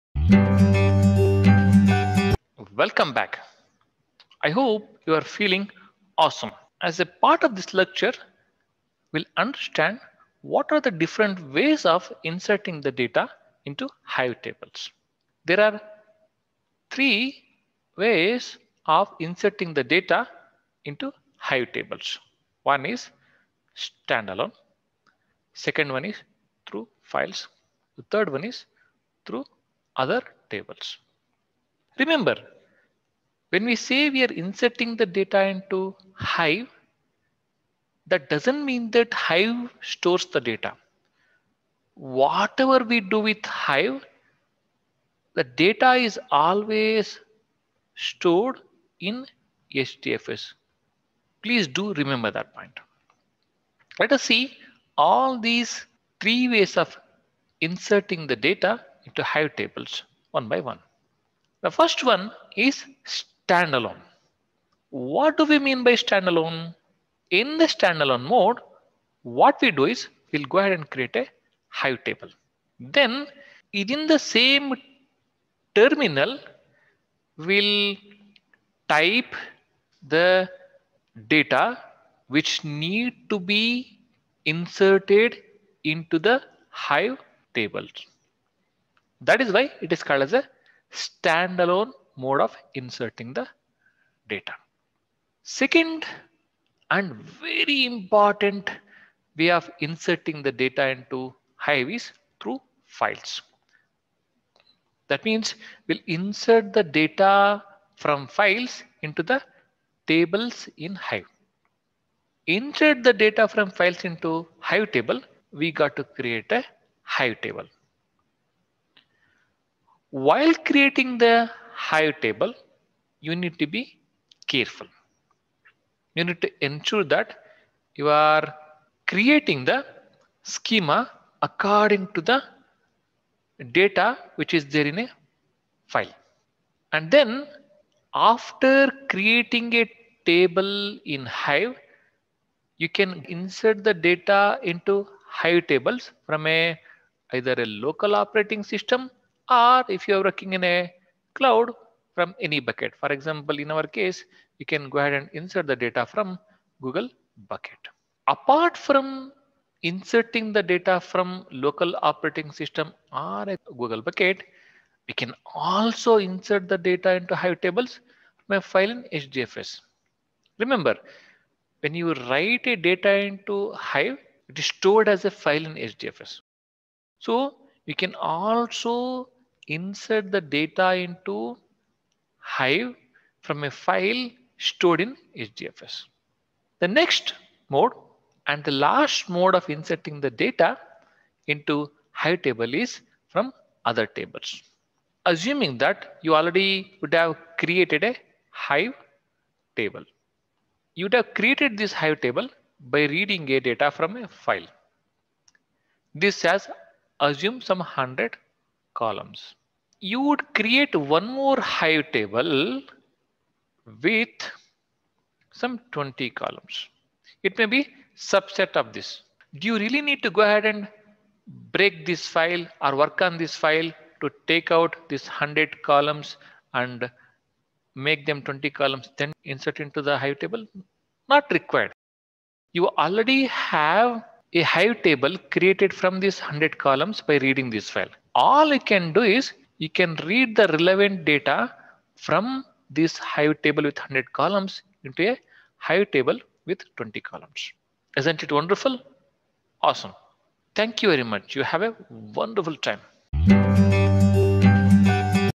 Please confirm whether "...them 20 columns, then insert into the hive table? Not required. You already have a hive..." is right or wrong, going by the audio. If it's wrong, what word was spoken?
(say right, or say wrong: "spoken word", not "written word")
right.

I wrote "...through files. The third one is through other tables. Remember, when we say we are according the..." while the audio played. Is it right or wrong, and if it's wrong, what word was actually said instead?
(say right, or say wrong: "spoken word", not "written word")
wrong: "inserting", not "according".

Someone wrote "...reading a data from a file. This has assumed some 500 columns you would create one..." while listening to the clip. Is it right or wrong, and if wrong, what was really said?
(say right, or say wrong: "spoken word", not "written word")
wrong: "100", not "500".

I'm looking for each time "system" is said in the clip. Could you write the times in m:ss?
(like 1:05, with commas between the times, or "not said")
2:28, 2:42.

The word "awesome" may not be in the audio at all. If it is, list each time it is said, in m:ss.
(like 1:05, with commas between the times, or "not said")
0:06, 4:09.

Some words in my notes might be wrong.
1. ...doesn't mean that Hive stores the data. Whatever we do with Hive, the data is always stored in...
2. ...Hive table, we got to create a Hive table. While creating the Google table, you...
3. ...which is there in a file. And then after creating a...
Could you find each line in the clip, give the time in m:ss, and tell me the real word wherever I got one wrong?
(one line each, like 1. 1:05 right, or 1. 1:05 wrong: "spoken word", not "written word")
1. 0:38 right
2. 1:54 wrong: "Hive", not "Google"
3. 2:14 right.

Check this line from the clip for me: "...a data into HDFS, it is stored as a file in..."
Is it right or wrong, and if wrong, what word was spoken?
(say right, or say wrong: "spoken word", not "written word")
wrong: "Hive", not "HDFS".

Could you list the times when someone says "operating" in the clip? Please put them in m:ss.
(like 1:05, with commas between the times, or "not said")
2:28, 2:42.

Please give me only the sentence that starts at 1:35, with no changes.
Second, and very important way of inserting the data into Hive is through files.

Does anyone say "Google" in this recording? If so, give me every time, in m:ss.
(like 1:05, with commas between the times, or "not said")
2:36, 2:43.